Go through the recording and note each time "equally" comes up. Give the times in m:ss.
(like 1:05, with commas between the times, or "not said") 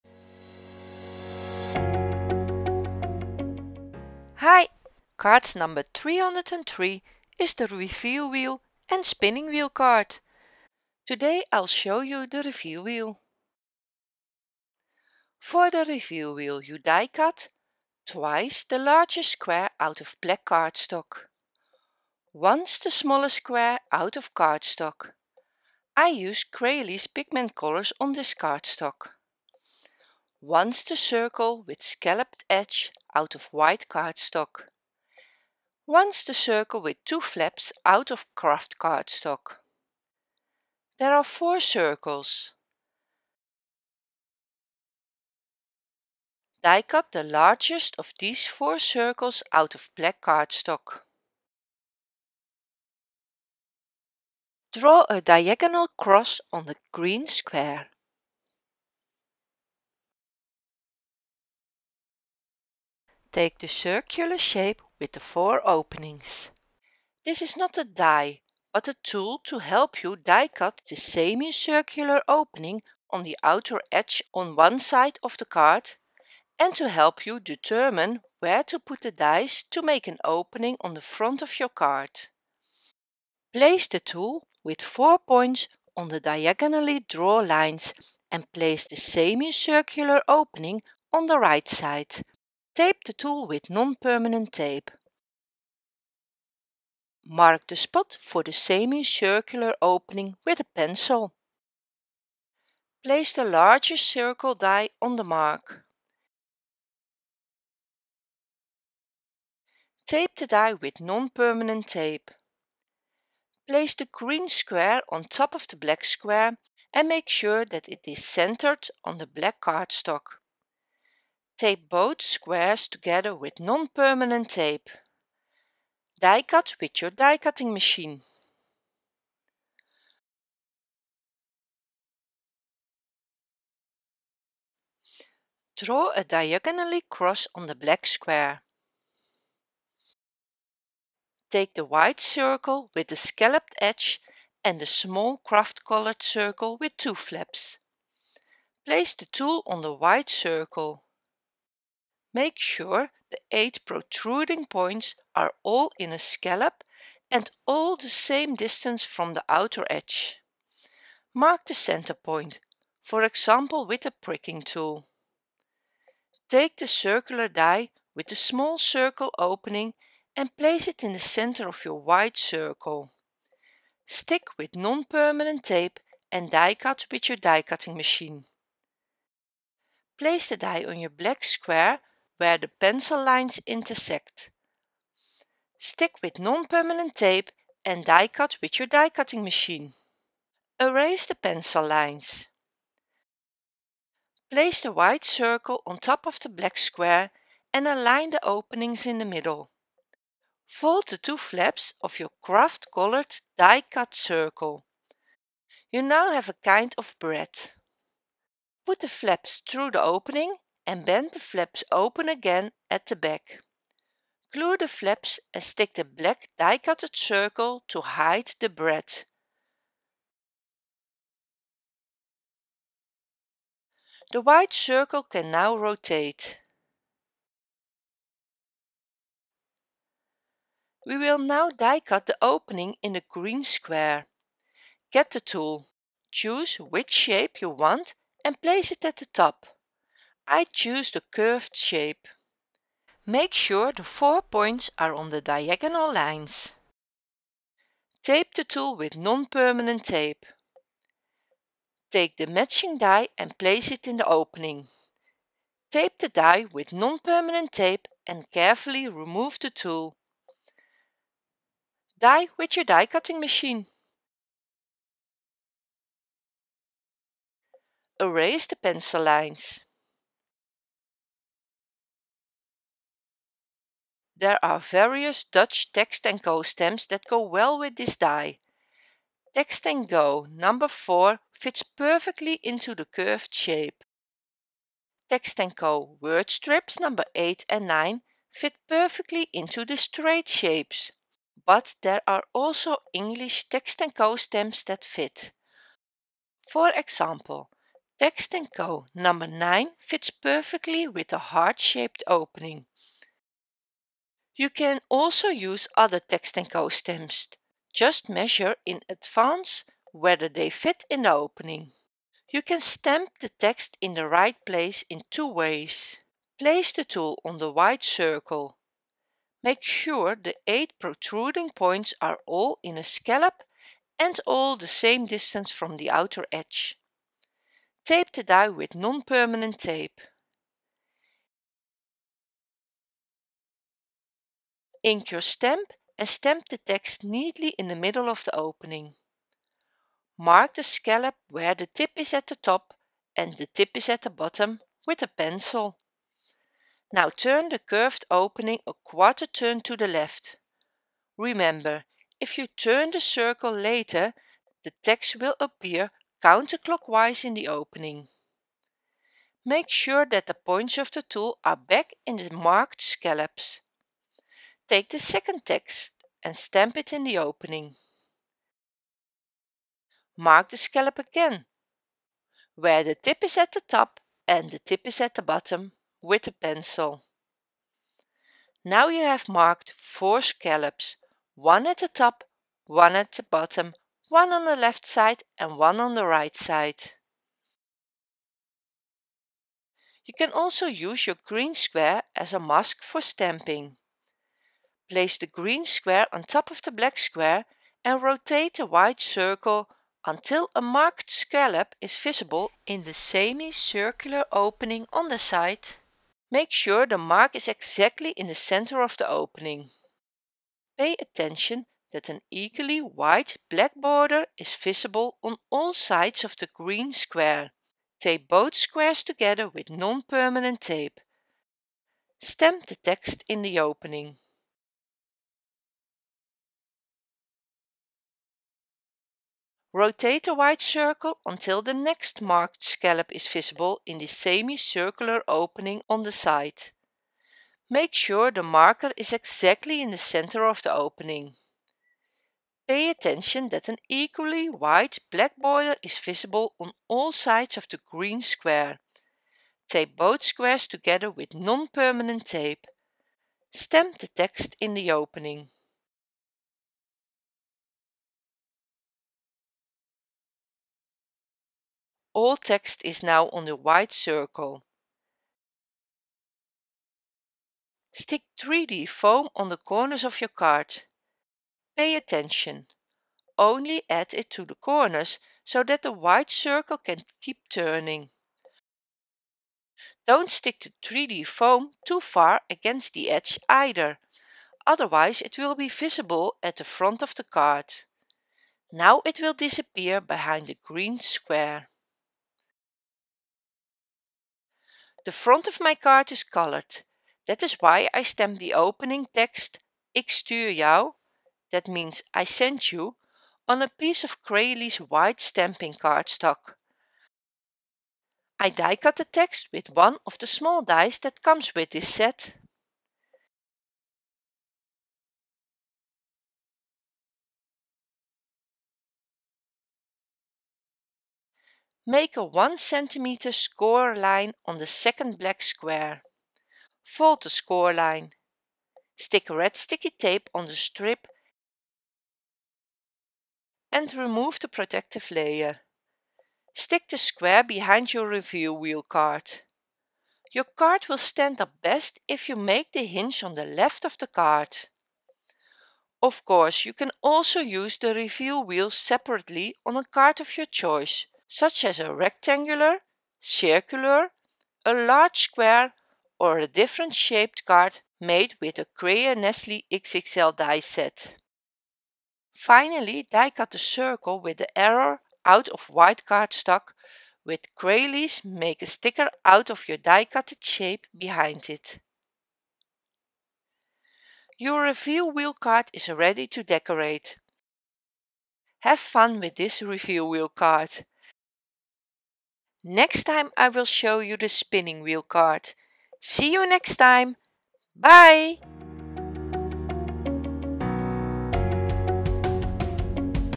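6:52, 7:24.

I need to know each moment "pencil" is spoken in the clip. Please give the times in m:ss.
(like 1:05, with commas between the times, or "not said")
1:40, 3:02, 3:11, 4:28, 5:45, 6:16.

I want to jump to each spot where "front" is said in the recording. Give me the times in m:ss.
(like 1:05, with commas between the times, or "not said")
1:21, 8:06, 8:15.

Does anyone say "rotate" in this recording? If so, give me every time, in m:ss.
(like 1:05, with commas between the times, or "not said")
3:45, 6:38, 7:09.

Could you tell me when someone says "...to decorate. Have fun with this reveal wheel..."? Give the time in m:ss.
9:36.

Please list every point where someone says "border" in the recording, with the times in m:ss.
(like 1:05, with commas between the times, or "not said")
6:53, 7:25.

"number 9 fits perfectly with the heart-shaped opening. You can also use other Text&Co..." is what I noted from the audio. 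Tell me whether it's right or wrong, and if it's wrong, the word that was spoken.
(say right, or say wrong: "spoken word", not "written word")
right.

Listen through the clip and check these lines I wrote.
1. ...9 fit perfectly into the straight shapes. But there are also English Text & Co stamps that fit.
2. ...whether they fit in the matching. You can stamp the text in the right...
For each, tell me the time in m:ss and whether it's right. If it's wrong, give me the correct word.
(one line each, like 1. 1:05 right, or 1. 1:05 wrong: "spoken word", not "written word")
1. 4:47 right
2. 5:10 wrong: "opening", not "matching".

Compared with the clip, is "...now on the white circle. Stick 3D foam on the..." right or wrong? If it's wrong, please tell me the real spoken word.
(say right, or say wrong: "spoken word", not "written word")
right.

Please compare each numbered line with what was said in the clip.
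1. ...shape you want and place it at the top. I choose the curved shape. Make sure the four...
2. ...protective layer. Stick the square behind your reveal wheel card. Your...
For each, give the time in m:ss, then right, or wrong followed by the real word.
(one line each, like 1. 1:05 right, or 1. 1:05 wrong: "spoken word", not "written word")
1. 3:57 right
2. 8:54 right.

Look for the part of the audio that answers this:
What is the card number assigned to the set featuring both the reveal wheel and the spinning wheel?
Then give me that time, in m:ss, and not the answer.
0:05.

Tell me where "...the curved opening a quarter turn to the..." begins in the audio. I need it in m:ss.
5:47.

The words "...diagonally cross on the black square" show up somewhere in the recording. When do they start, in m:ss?
2:16.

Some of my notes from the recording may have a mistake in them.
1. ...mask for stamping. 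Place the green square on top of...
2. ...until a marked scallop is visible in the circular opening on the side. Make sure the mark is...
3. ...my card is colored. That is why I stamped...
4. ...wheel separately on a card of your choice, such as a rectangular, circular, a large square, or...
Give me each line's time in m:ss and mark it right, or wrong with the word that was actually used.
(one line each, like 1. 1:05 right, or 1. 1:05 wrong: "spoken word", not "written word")
1. 6:32 right
2. 6:40 wrong: "semicircular", not "circular"
3. 8:15 right
4. 9:08 right.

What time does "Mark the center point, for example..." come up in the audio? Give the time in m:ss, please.
2:41.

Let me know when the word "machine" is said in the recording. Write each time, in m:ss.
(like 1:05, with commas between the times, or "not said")
2:07, 2:57, 3:09, 4:23.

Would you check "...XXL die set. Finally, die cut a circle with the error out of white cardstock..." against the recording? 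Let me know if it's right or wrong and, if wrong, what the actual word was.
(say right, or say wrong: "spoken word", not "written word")
right.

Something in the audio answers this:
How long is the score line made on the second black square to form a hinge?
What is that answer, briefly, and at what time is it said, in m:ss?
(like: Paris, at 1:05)
1 cm, at 8:42.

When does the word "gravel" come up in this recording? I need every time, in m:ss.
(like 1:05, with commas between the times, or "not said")
not said.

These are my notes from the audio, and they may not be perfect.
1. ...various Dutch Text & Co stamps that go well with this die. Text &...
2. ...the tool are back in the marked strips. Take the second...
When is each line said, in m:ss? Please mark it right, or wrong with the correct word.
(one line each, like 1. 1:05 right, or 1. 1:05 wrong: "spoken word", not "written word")
1. 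4:34 right
2. 6:01 wrong: "scallops", not "strips".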